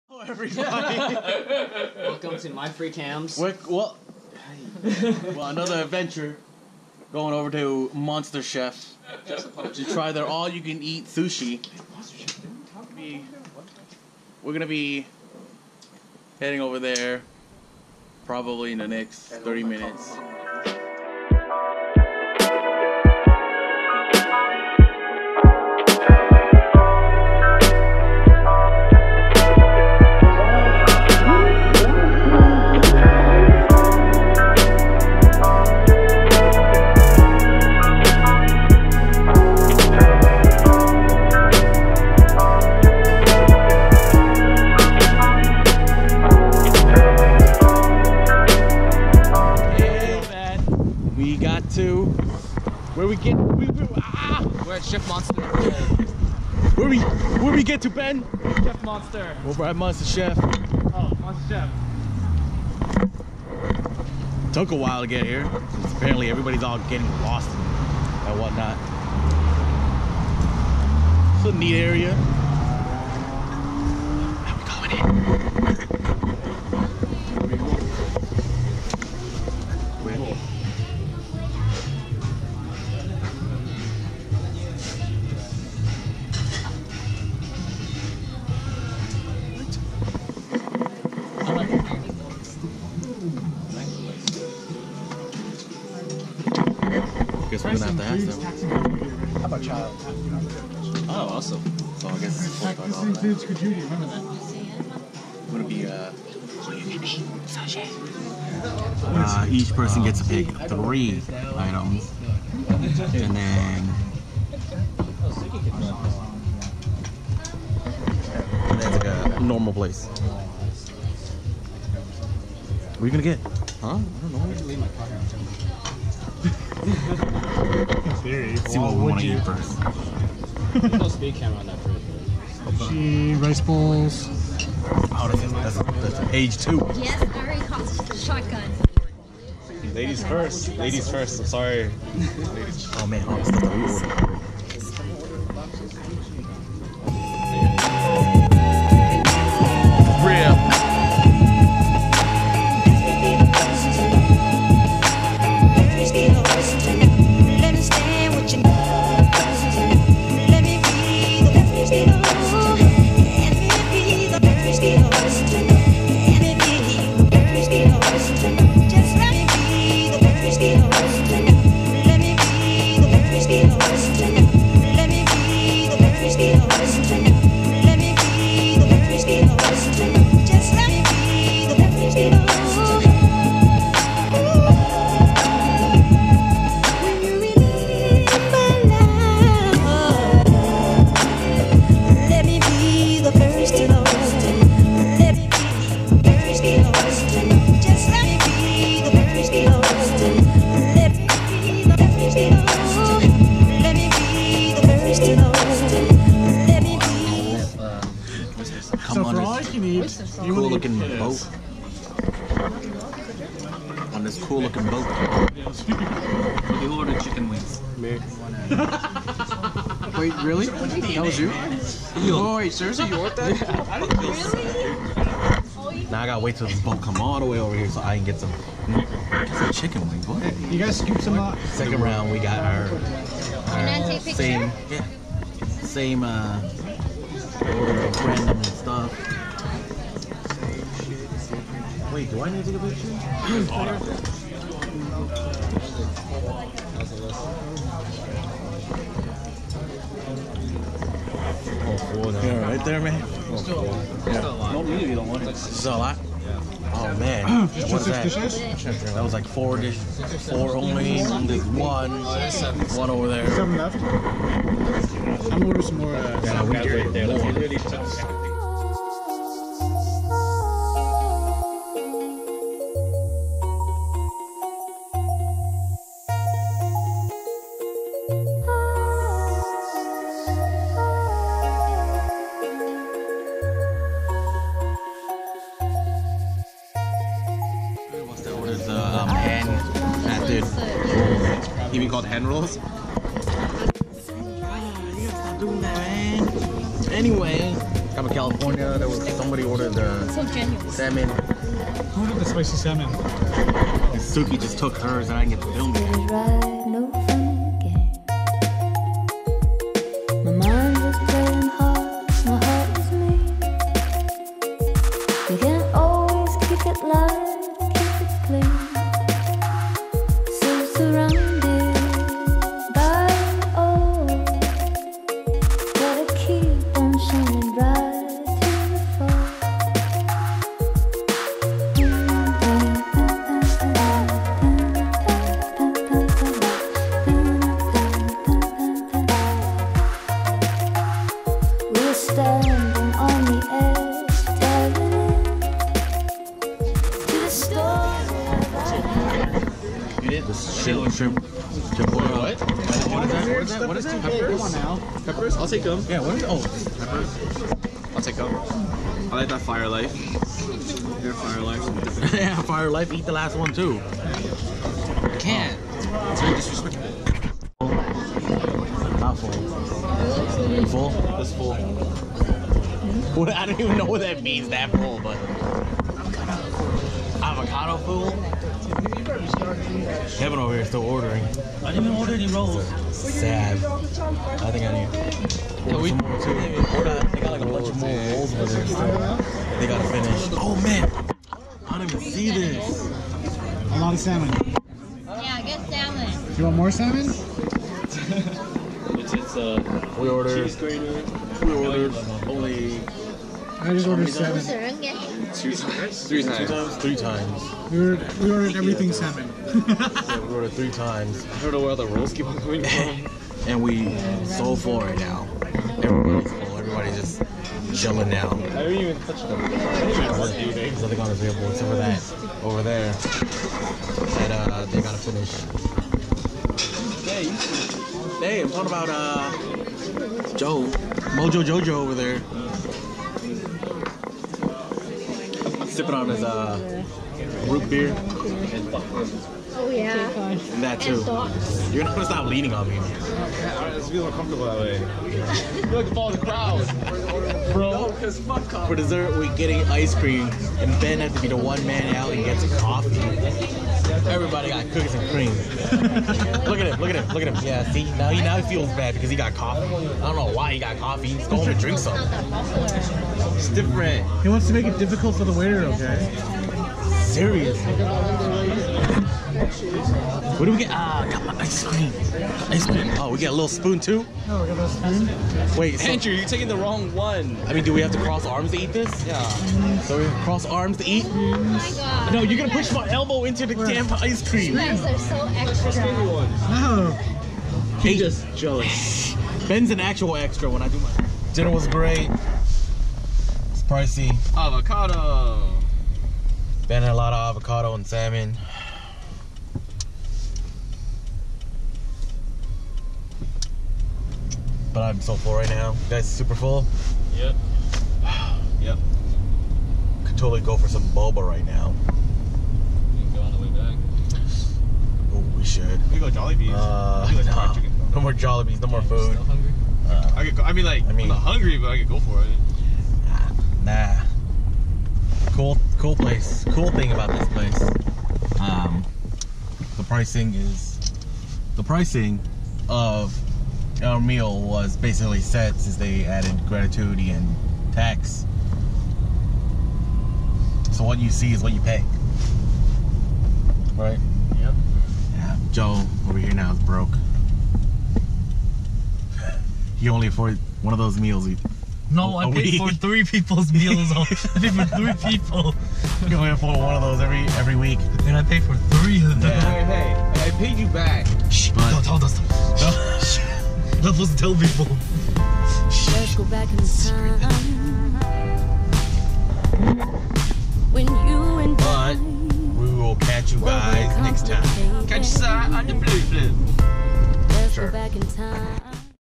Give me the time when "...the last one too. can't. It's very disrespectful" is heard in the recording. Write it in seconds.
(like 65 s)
363 s.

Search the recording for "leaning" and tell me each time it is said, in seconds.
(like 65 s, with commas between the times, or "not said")
442 s.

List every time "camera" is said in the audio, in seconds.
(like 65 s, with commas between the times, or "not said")
131 s.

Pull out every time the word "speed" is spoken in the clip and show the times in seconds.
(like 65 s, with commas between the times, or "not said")
131 s.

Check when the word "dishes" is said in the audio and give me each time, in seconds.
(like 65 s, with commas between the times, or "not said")
259 s.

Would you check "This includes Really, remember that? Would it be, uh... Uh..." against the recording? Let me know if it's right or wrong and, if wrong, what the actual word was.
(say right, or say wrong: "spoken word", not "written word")
wrong: "Kajudi", not "Really".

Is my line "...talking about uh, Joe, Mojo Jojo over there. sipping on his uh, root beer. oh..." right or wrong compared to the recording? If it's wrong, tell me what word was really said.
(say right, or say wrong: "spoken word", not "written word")
right.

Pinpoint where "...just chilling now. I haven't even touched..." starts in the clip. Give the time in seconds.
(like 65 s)
417 s.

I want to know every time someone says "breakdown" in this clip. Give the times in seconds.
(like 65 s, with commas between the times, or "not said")
not said.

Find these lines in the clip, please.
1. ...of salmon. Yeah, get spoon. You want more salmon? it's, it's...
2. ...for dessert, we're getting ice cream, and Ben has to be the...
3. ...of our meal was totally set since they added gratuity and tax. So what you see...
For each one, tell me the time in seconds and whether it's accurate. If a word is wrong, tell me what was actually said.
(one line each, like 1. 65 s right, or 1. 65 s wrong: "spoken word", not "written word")
1. 394 s wrong: "salmon", not "spoon"
2. 448 s right
3. 532 s wrong: "basically", not "totally".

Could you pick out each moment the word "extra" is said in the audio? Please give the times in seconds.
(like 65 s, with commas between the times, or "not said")
485 s, 490 s.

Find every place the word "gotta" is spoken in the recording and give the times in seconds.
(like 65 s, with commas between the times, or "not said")
226 s, 389 s, 425 s.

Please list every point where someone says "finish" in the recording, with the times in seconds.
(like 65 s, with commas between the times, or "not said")
390 s, 425 s.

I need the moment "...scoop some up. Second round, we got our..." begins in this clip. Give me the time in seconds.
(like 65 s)
230 s.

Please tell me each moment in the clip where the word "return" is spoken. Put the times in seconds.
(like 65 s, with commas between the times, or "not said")
not said.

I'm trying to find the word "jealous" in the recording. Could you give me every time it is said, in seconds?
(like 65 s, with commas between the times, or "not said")
488 s.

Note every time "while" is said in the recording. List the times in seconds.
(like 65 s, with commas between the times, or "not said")
64 s.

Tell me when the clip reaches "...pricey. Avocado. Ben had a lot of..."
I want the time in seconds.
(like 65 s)
493 s.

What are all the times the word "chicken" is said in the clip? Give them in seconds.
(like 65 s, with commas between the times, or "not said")
217 s, 229 s.